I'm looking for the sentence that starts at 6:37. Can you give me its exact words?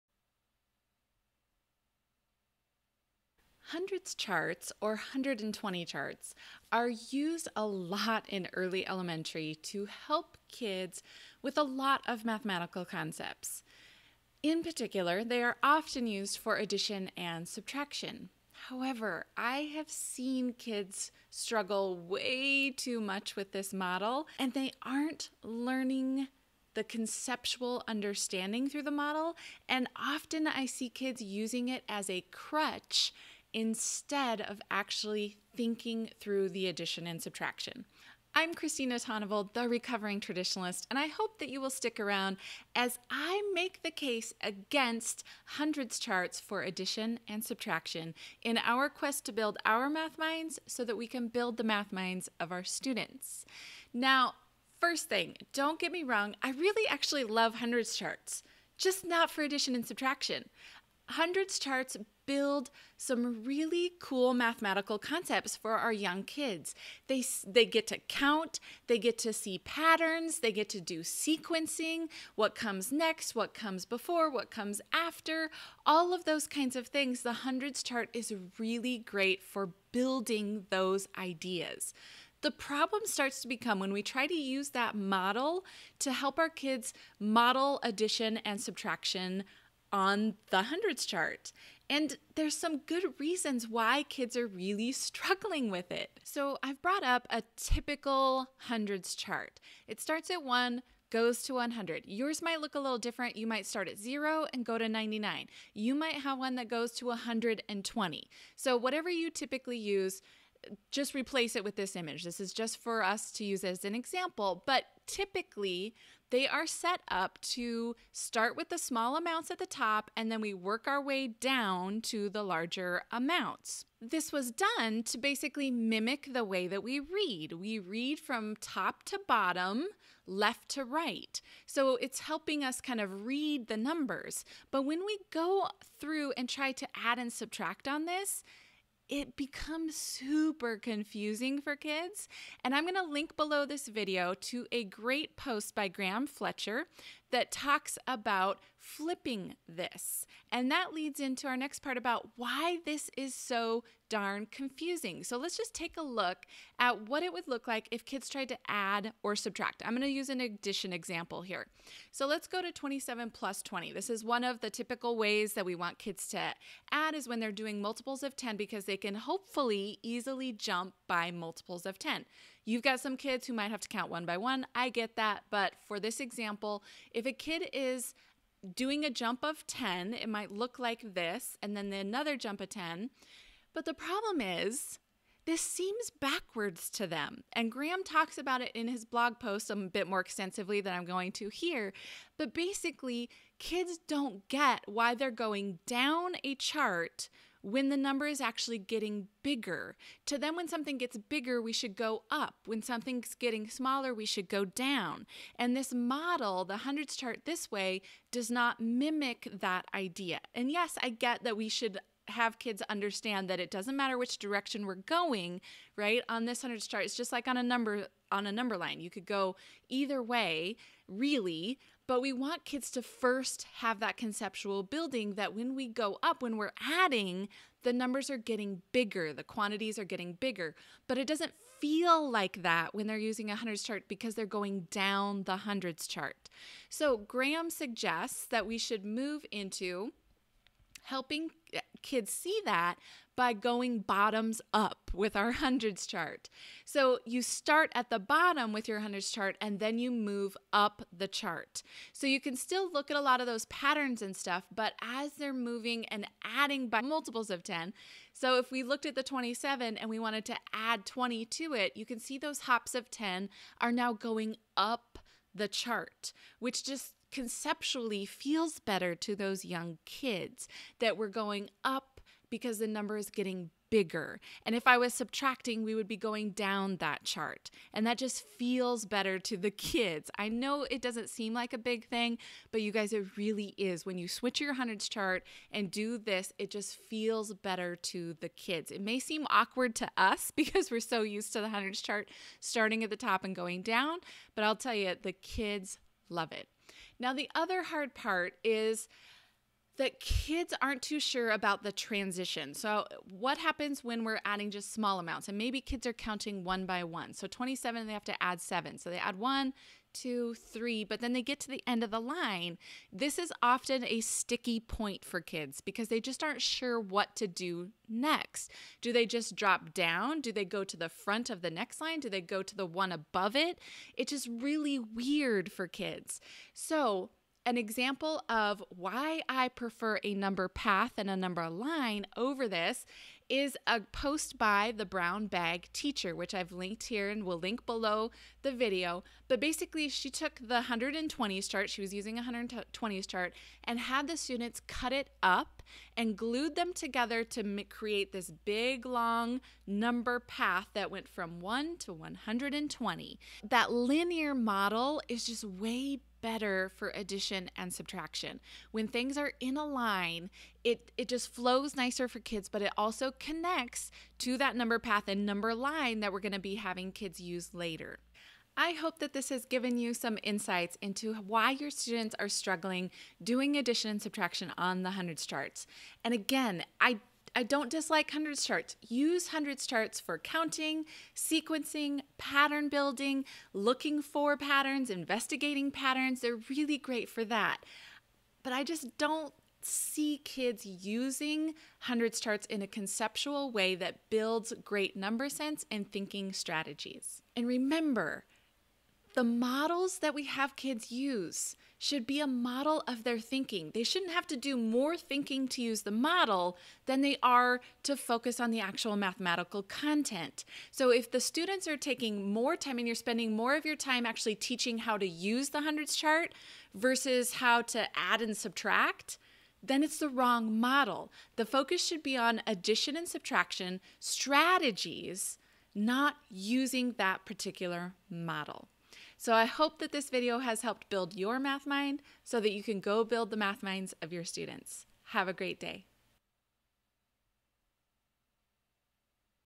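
And remember, the models that we have kids use should be a model of their thinking.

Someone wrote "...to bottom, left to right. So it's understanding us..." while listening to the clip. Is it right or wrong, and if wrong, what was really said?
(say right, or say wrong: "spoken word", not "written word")
wrong: "helping", not "understanding".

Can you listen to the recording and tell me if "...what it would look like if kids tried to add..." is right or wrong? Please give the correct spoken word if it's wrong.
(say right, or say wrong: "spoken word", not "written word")
right.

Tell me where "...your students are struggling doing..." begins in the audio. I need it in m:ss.
6:11.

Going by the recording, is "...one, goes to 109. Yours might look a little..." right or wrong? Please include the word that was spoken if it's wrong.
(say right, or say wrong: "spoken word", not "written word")
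wrong: "100", not "109".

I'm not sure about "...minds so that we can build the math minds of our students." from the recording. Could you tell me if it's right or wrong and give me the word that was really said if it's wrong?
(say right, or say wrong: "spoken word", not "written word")
right.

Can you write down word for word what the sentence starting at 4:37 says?
And that just feels better to the kids.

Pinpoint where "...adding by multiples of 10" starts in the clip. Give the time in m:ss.
4:16.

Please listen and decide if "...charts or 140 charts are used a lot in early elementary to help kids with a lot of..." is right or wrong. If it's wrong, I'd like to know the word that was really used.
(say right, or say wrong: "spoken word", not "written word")
wrong: "120", not "140".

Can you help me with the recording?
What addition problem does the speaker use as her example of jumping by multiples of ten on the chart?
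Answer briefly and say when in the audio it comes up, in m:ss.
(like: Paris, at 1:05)
27 plus 20, at 2:42.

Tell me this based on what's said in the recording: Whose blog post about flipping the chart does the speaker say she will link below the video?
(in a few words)
Graham Fletcher.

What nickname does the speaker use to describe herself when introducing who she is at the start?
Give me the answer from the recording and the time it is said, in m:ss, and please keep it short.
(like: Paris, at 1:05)
the recovering traditionalist, at 0:39.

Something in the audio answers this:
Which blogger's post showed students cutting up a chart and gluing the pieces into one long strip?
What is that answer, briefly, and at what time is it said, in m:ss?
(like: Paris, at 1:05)
the Brown Bag Teacher, at 5:34.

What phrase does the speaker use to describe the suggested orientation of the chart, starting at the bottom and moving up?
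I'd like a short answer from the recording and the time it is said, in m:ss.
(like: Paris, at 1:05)
bottoms up, at 4:03.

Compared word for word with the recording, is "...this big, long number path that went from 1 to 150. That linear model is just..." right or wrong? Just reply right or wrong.
wrong.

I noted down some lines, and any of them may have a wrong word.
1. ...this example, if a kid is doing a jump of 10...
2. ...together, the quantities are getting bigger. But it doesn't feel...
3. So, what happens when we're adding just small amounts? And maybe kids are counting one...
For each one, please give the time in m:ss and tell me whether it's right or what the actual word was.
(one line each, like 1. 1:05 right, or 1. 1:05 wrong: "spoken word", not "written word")
1. 2:55 right
2. 3:48 wrong: "bigger", not "together"
3. 5:02 right.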